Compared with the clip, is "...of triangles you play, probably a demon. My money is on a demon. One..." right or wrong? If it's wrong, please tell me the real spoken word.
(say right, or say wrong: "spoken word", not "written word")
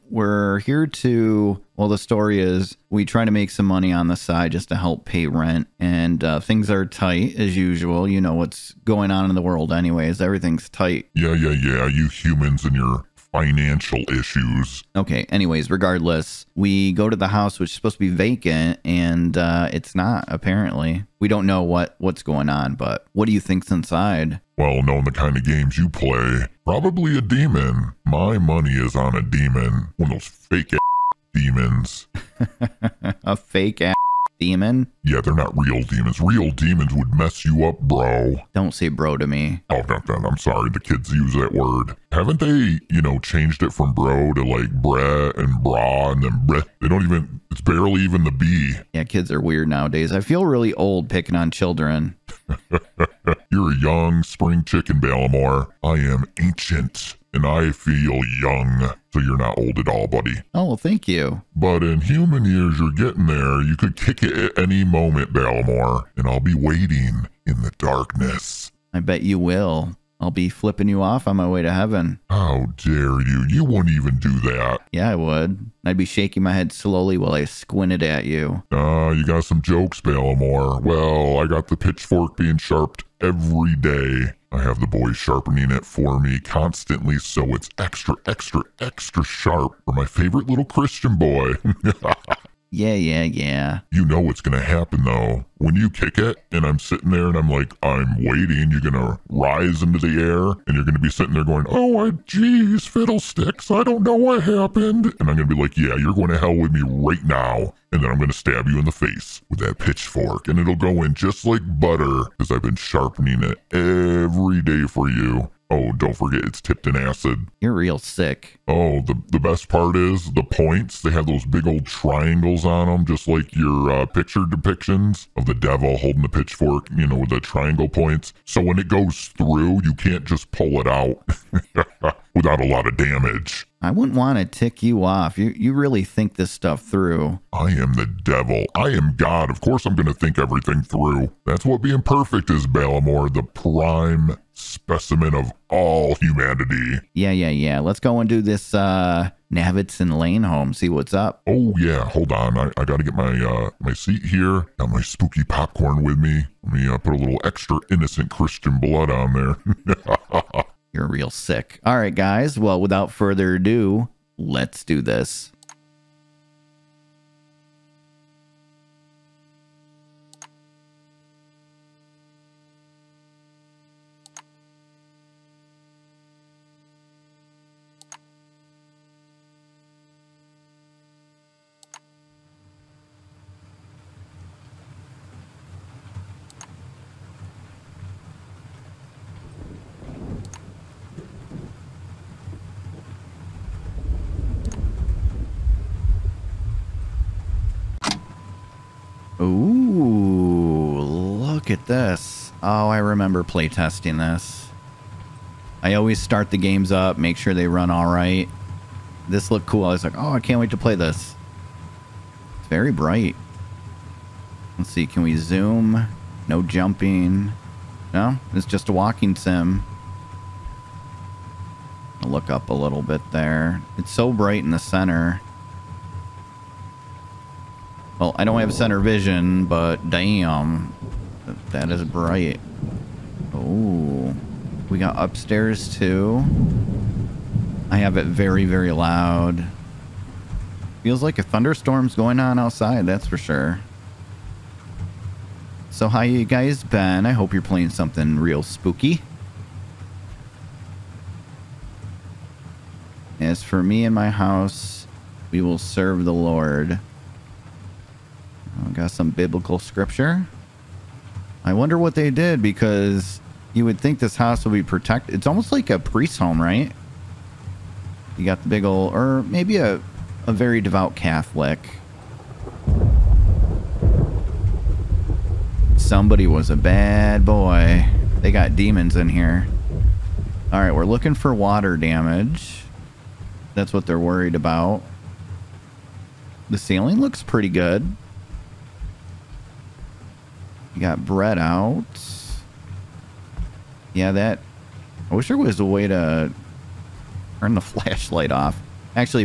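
wrong: "games", not "triangles".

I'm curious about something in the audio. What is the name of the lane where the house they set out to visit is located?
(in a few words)
Navitz Lane.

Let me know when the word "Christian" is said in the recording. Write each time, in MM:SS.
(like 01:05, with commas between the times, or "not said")
01:30, 02:38.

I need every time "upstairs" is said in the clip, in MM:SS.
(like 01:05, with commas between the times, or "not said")
03:55.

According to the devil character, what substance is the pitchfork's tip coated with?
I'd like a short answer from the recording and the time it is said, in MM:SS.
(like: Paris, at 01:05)
Acid, at 01:56.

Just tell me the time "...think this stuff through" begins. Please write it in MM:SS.
02:16.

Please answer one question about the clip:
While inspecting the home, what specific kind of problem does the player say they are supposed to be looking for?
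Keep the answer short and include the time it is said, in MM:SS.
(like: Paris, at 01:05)
Water damage, at 04:41.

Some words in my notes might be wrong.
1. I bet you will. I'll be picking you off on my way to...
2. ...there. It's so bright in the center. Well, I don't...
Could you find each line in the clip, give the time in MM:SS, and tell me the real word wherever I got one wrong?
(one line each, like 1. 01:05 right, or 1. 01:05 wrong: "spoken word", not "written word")
1. 01:08 wrong: "flipping", not "picking"
2. 03:43 right.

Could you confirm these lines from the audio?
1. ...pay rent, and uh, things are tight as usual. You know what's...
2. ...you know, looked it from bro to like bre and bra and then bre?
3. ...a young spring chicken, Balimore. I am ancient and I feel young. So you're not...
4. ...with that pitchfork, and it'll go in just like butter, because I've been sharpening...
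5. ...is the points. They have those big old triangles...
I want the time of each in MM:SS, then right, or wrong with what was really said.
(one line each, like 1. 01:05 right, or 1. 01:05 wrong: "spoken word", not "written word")
1. 00:05 right
2. 00:42 wrong: "changed", not "looked"
3. 00:53 right
4. 01:49 right
5. 01:59 right.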